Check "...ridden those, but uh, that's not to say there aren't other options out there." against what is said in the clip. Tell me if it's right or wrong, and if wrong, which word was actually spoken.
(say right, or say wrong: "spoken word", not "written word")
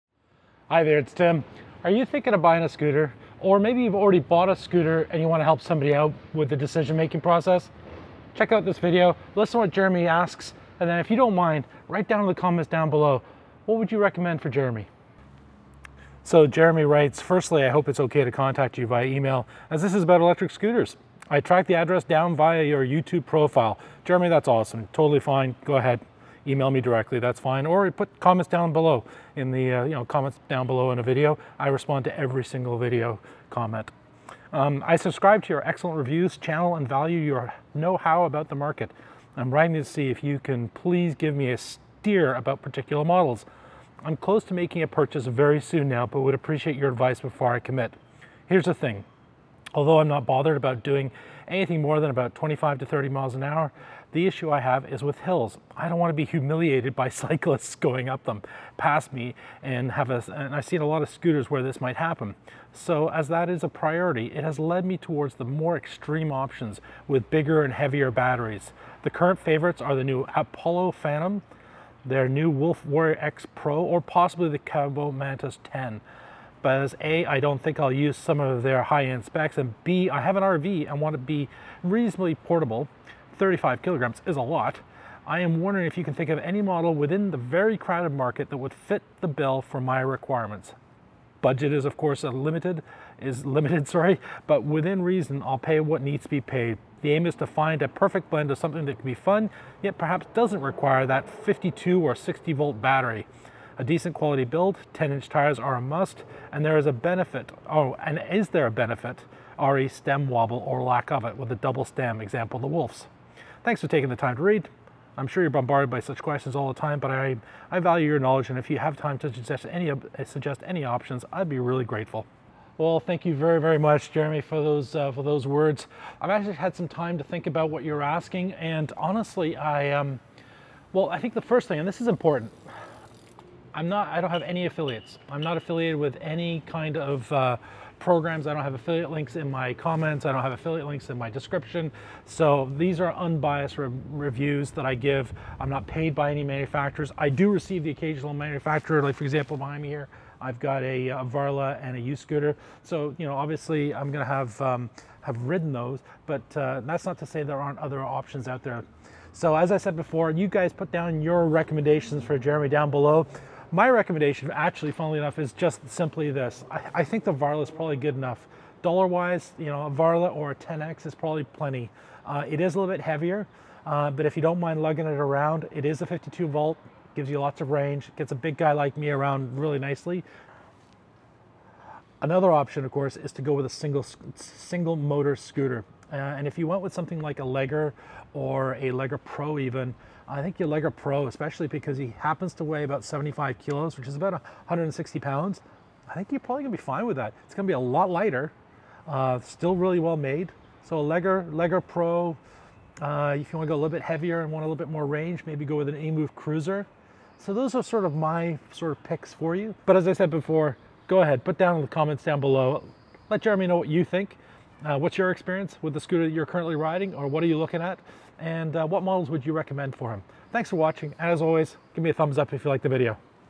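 right.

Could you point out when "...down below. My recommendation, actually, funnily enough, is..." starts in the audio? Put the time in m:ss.
2:42.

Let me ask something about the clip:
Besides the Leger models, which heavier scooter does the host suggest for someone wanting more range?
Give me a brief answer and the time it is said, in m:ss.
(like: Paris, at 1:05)
EMOVE Cruiser, at 3:25.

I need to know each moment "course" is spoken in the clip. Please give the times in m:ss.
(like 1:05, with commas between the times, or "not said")
1:31, 3:02.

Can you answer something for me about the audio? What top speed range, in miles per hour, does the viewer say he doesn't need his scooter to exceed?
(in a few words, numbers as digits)
25 to 30.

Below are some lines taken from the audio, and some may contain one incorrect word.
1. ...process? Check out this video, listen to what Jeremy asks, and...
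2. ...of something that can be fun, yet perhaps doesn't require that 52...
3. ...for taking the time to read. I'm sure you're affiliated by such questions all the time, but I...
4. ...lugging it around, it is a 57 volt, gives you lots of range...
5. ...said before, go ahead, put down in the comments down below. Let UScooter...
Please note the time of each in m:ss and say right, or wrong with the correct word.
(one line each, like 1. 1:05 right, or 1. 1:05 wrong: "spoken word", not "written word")
1. 0:07 right
2. 1:38 right
3. 1:53 wrong: "bombarded", not "affiliated"
4. 2:54 wrong: "52", not "57"
5. 3:30 wrong: "Jeremy", not "UScooter".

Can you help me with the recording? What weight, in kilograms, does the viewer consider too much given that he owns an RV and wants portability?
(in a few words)
35 kilograms.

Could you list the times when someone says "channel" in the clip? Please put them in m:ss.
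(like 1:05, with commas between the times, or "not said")
0:36.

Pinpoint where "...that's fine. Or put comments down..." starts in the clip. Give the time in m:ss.
0:27.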